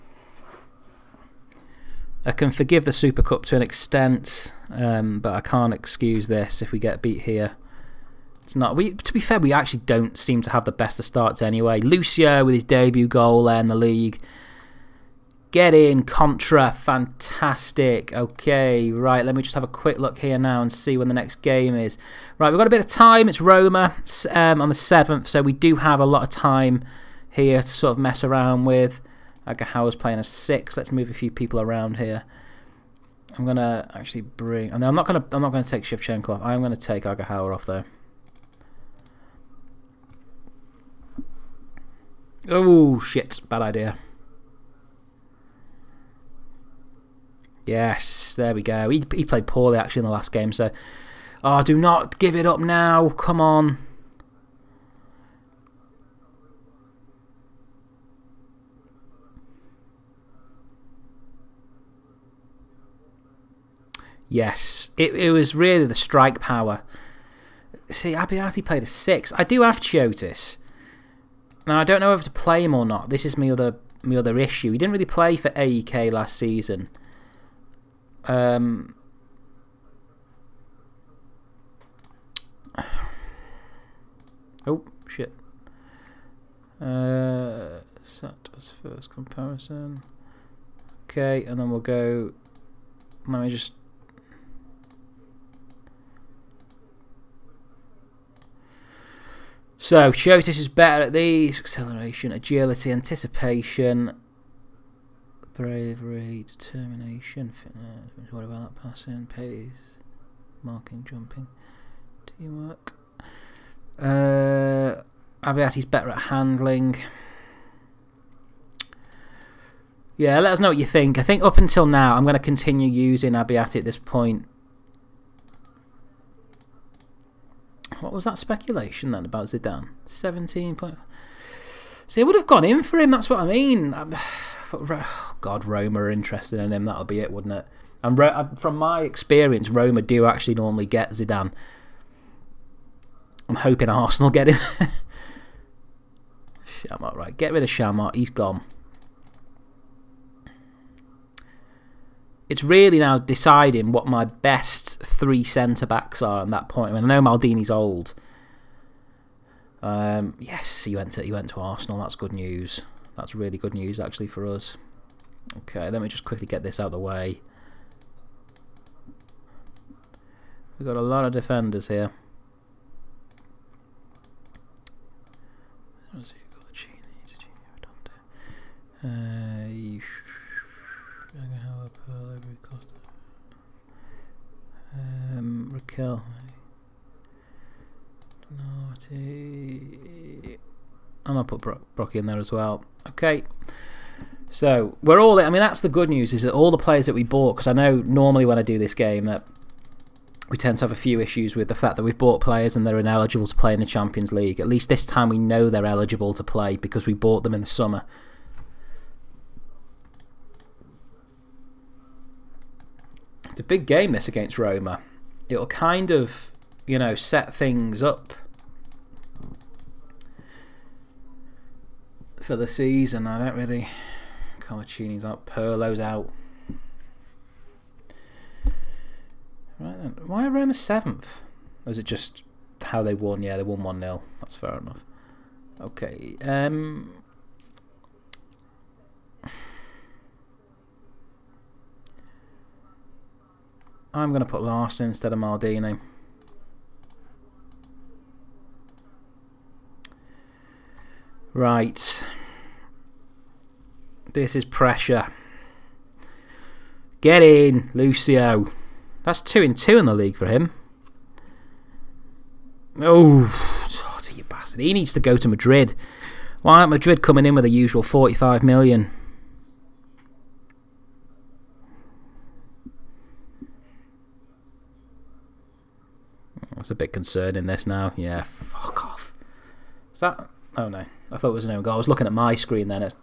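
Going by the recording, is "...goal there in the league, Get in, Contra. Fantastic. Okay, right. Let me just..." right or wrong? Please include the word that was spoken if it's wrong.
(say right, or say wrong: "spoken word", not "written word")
right.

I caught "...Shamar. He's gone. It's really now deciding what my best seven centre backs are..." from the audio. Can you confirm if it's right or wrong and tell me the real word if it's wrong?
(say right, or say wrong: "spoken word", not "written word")
wrong: "three", not "seven".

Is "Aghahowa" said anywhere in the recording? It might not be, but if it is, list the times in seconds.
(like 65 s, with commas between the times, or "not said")
29 s, 37 s.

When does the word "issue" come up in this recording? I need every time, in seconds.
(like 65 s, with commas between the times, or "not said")
74 s, 201 s.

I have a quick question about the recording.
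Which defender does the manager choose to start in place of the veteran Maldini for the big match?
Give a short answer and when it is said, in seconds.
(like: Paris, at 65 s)
Laursen, at 244 s.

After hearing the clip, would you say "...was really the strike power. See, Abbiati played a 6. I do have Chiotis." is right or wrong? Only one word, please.
right.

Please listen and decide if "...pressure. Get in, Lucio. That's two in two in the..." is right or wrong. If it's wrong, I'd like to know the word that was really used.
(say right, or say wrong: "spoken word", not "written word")
right.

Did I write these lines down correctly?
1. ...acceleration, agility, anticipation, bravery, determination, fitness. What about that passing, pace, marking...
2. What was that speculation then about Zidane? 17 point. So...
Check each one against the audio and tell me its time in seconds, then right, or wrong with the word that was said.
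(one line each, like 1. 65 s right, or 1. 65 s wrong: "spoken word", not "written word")
1. 101 s right
2. 128 s right.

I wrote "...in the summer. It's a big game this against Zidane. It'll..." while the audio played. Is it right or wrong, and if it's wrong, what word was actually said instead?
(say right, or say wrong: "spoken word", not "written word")
wrong: "Roma", not "Zidane".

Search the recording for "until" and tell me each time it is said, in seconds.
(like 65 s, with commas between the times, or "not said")
121 s.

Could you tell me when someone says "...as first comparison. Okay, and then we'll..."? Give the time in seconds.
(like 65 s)
88 s.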